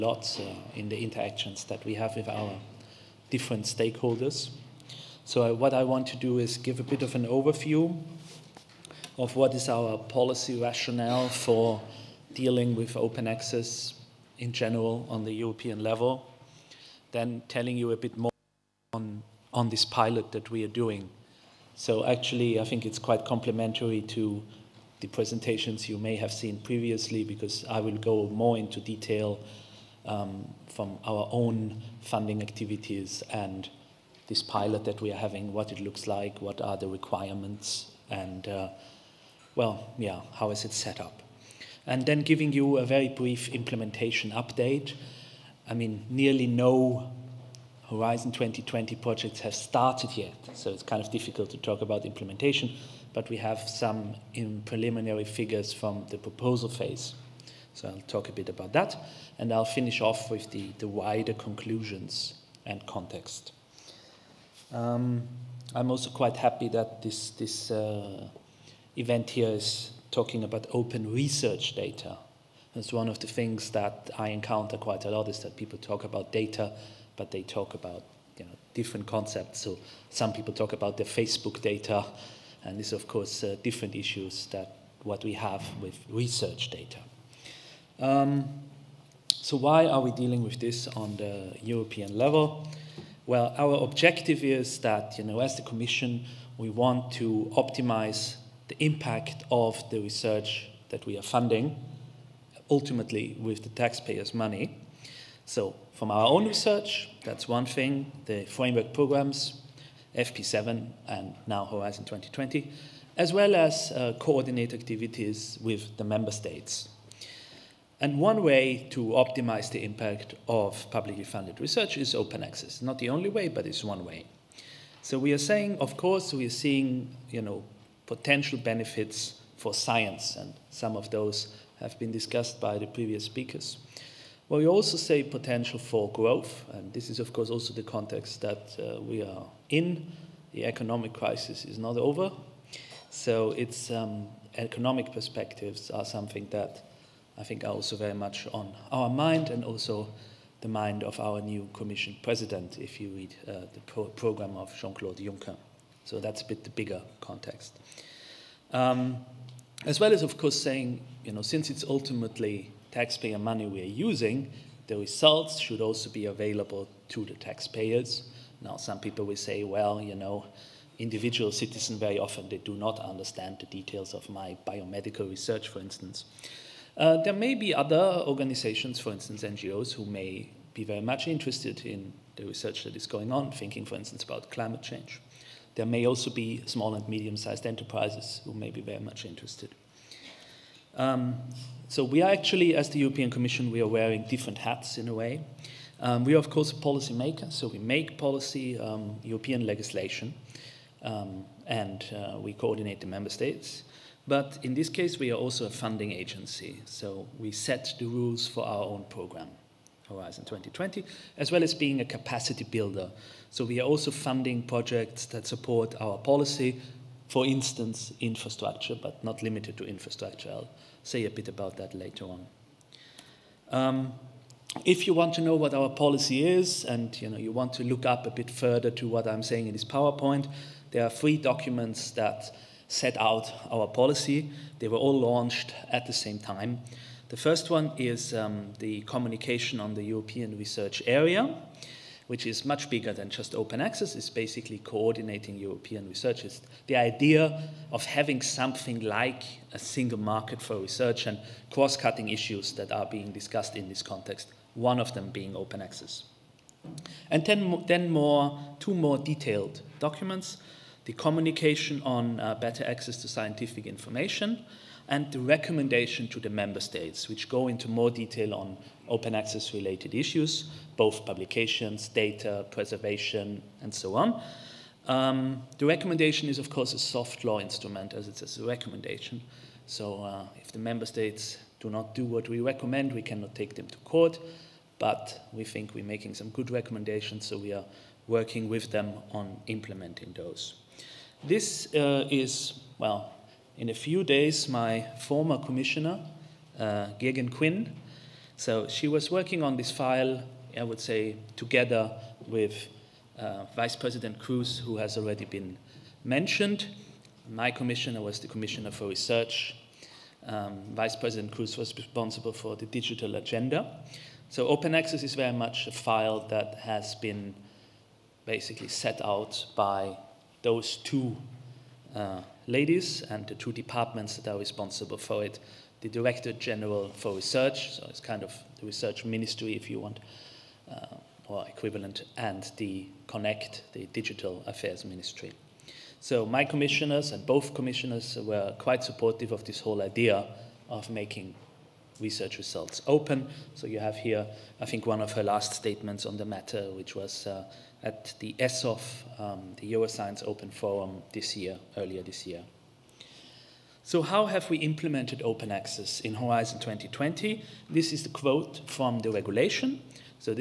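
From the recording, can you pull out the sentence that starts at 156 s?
So that's a bit the bigger context.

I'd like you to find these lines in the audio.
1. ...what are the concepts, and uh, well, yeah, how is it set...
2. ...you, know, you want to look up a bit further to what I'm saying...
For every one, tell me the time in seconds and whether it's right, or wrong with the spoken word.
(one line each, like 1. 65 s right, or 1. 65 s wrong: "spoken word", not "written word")
1. 36 s wrong: "requirements", not "concepts"
2. 227 s right.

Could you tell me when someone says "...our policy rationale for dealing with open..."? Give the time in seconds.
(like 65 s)
9 s.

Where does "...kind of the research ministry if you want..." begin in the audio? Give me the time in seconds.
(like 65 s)
328 s.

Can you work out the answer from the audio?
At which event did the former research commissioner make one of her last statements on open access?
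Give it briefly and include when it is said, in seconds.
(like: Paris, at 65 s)
Euroscience Open Forum, at 349 s.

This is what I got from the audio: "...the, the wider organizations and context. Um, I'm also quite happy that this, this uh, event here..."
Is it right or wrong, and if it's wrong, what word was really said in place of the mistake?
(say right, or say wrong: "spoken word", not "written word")
wrong: "conclusions", not "organizations".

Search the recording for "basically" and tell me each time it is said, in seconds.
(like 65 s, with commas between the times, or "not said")
244 s, 318 s.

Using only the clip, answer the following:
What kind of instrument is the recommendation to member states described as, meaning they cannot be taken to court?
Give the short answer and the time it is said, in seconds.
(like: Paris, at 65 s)
soft law instrument, at 276 s.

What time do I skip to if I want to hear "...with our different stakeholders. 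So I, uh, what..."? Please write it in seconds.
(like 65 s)
2 s.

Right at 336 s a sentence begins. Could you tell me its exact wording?
So my commissioners and both commissioners were quite supportive of this whole idea of making research results open.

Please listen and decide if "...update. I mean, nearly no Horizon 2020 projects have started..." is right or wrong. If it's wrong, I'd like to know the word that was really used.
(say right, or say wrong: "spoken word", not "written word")
right.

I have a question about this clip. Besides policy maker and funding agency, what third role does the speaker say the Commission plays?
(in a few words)
capacity builder.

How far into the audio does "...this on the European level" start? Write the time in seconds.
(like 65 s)
90 s.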